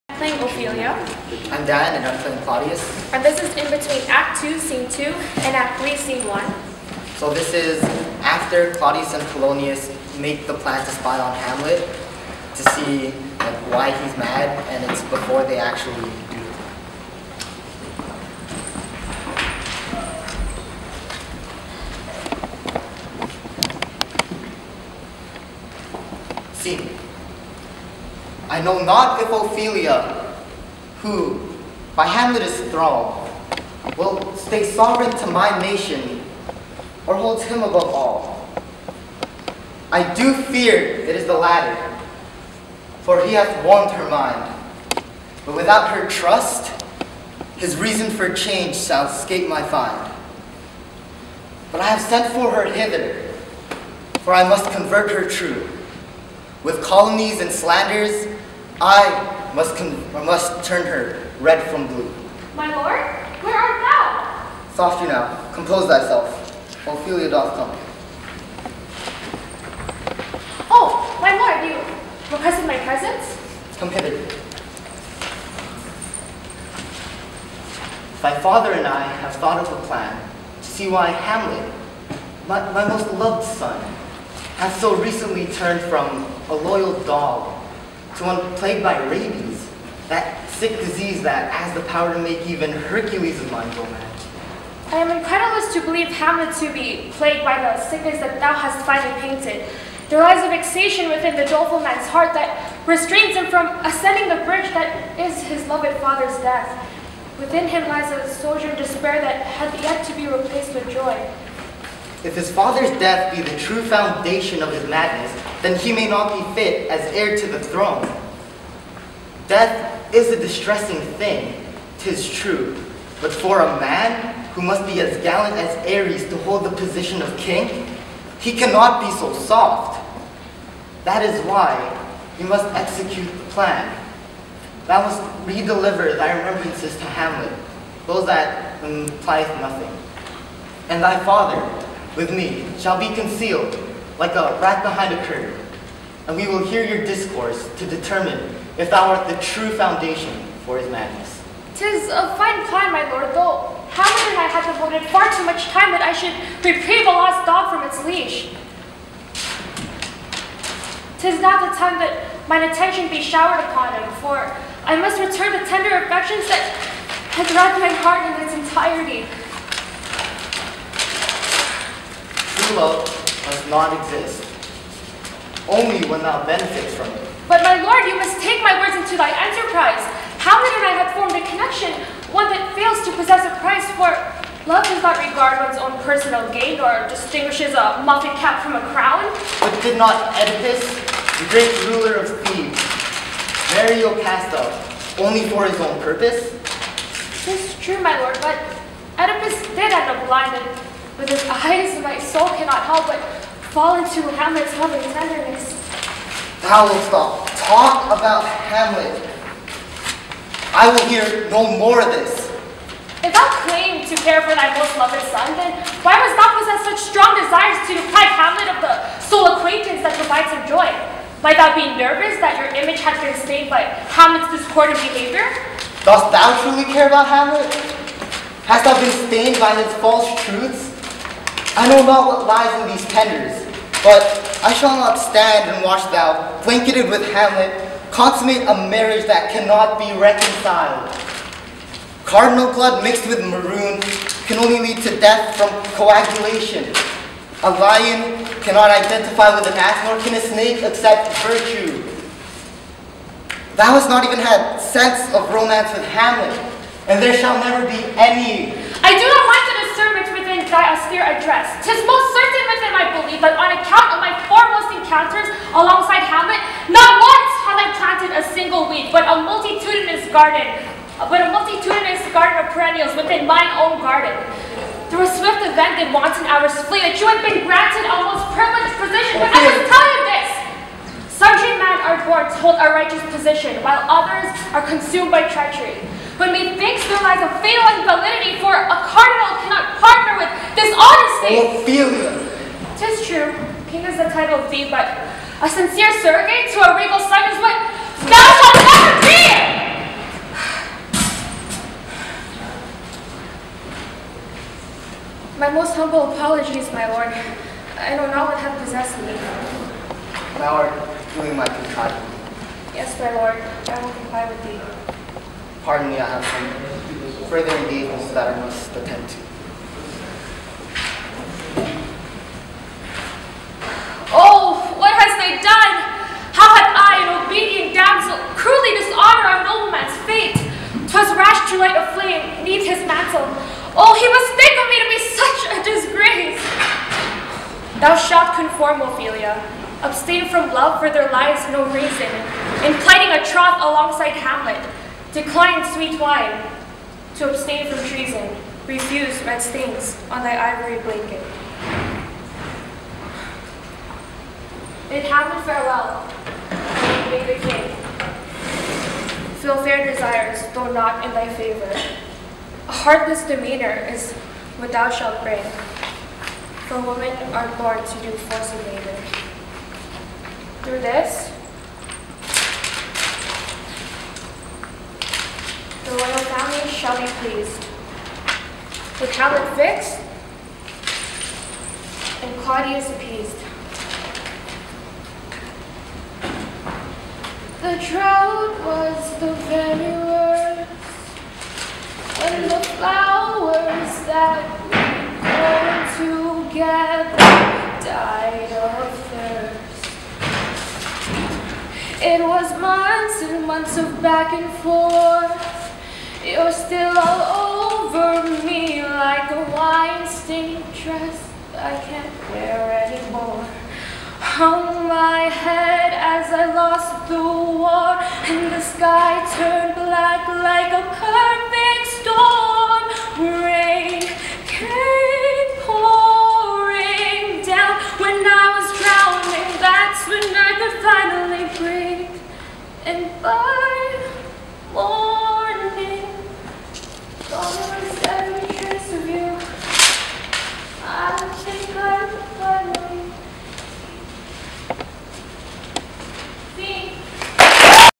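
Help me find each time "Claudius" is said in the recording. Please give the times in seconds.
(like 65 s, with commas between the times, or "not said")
2 s, 8 s, 382 s.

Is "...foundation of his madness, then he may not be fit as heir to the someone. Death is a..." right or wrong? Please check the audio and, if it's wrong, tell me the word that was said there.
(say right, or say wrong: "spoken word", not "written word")
wrong: "throne", not "someone".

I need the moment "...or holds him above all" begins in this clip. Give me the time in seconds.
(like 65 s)
37 s.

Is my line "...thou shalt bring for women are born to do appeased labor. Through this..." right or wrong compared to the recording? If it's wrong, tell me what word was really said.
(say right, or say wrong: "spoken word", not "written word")
wrong: "forced", not "appeased".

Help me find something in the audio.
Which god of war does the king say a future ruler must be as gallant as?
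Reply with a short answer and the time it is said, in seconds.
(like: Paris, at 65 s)
Ares, at 125 s.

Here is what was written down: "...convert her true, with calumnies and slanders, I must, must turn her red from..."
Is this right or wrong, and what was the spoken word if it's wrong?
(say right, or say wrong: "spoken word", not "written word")
right.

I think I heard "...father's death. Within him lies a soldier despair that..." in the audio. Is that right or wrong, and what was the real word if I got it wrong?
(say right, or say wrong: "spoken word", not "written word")
right.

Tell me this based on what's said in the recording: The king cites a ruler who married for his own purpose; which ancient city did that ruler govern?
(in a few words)
Thebes.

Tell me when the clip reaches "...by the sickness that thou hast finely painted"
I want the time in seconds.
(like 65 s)
97 s.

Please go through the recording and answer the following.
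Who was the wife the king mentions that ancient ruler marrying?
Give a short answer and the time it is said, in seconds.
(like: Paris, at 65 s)
Jocasta, at 194 s.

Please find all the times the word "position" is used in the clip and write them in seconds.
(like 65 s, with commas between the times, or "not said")
126 s, 278 s, 283 s.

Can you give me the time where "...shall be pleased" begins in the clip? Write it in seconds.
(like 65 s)
376 s.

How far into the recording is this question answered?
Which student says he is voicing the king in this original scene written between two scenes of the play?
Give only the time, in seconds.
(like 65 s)
1 s.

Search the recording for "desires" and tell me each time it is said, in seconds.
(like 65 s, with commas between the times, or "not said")
217 s, 360 s.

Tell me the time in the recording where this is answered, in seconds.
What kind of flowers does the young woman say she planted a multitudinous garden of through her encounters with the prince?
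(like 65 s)
272 s.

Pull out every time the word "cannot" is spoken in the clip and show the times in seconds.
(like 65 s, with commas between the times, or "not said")
128 s, 202 s, 239 s, 248 s, 289 s.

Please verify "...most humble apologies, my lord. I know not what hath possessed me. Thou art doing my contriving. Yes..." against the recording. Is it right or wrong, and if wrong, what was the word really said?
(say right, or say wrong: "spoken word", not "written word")
right.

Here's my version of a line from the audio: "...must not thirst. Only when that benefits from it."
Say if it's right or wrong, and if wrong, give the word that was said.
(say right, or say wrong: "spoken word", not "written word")
wrong: "exist", not "thirst".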